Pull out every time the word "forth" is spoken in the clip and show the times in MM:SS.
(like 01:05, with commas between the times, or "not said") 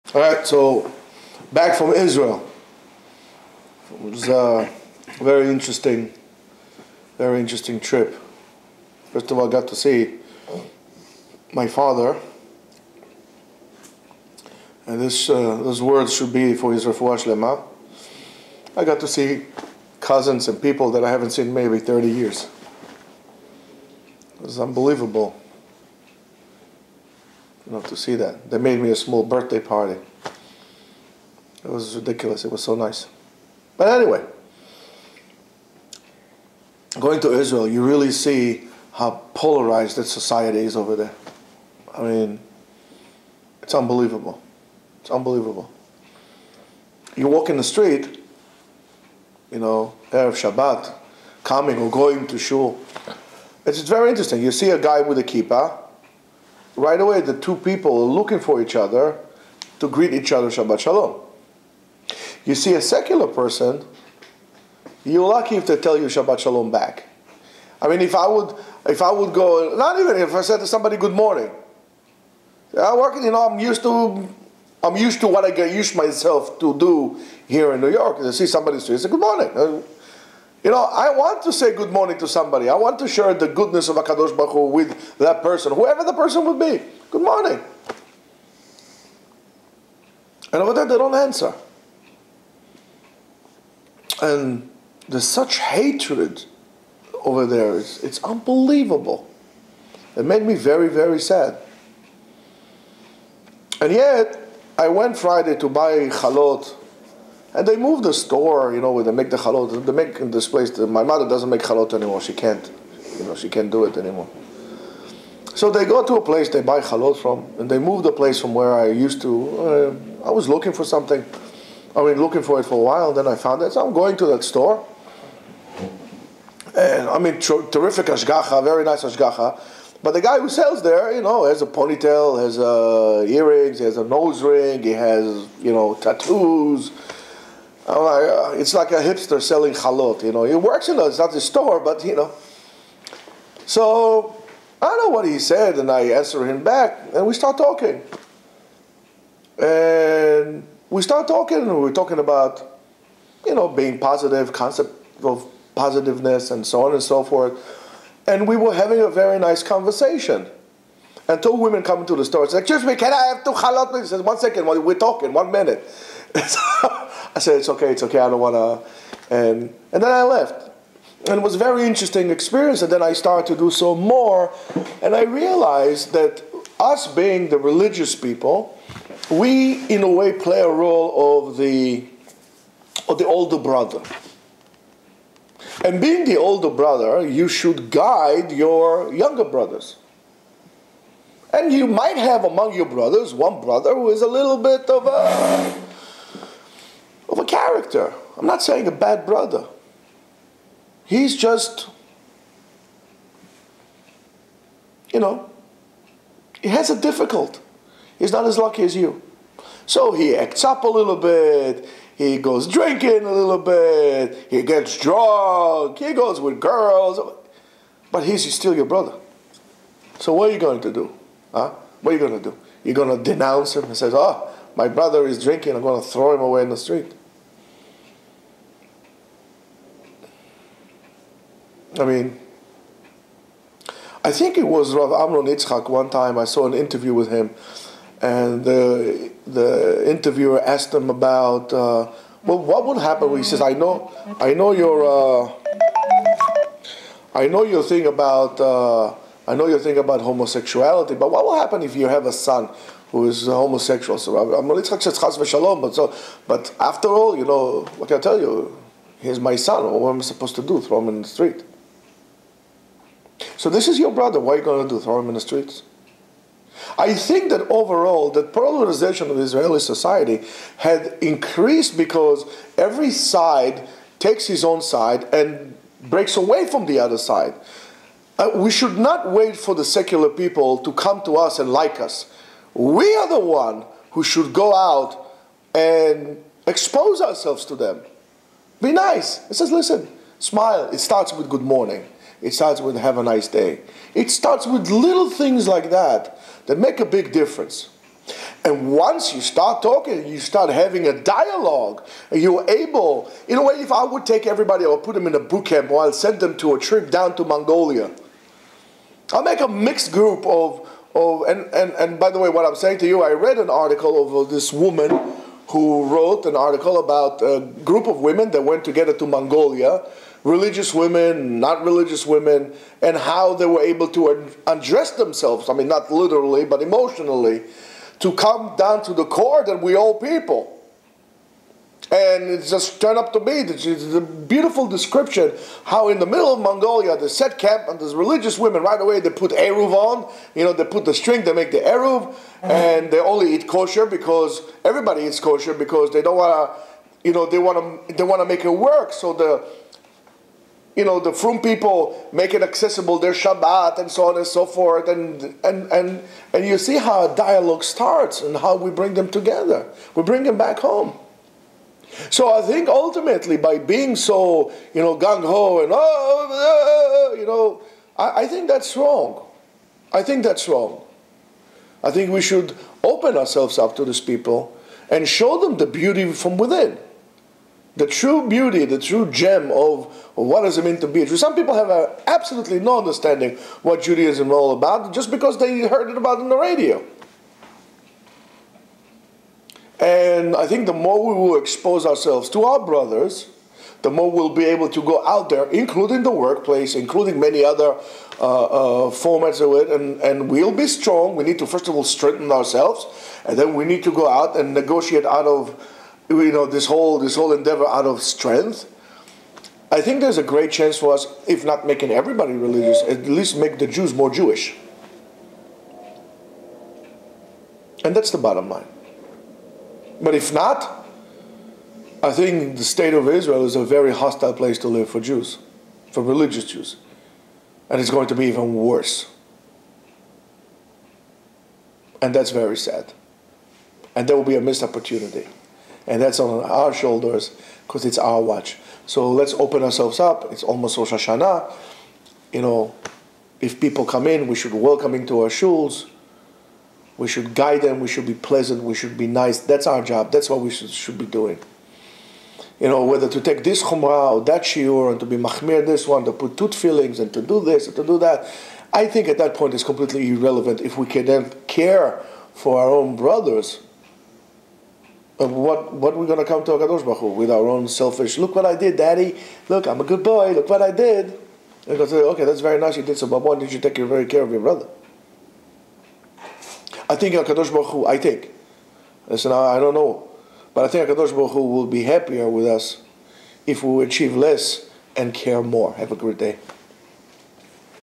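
02:37, 05:54.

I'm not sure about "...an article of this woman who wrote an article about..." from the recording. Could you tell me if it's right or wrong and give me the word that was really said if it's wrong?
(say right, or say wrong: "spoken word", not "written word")
right.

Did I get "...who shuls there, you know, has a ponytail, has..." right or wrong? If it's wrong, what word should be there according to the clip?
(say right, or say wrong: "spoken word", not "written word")
wrong: "sells", not "shuls".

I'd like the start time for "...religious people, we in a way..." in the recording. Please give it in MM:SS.
02:57.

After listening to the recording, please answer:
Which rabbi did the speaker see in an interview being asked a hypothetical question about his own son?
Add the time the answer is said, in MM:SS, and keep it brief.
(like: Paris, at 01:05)
Rav Amnon Yitzchak, at 03:54.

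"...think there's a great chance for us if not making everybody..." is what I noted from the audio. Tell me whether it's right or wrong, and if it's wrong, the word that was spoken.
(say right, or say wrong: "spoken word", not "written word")
right.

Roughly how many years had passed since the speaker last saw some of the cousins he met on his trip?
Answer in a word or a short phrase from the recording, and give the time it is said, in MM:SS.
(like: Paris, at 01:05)
30, at 00:21.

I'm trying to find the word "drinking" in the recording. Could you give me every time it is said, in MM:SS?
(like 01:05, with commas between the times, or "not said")
03:32, 03:45.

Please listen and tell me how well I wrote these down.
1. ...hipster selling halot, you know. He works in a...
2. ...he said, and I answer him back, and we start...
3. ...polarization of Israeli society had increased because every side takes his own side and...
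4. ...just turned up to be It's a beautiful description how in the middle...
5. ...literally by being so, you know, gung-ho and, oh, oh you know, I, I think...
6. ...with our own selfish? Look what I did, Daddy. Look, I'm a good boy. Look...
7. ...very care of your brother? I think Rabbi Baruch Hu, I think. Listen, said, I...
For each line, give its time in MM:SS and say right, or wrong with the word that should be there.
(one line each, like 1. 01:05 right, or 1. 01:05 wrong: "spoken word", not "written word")
1. 02:19 right
2. 02:25 right
3. 04:28 right
4. 05:32 right
5. 06:02 wrong: "ultimately", not "literally"
6. 07:47 right
7. 07:53 wrong: "Hakadosh", not "Rabbi".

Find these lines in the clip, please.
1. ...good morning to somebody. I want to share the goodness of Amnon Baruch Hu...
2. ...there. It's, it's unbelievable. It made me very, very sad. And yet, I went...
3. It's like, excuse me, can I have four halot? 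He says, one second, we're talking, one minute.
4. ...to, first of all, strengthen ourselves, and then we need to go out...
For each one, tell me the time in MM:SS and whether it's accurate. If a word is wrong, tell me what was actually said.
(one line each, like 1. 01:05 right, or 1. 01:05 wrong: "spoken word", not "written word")
1. 01:21 wrong: "Akadosh", not "Amnon"
2. 01:37 right
3. 02:42 wrong: "two", not "four"
4. 06:41 right.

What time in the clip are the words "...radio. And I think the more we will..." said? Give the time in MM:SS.
06:26.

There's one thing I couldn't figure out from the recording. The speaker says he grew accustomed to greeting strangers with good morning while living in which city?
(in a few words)
New York.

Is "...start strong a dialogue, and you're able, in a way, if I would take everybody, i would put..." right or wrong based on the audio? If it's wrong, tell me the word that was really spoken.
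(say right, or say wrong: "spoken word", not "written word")
wrong: "having", not "strong".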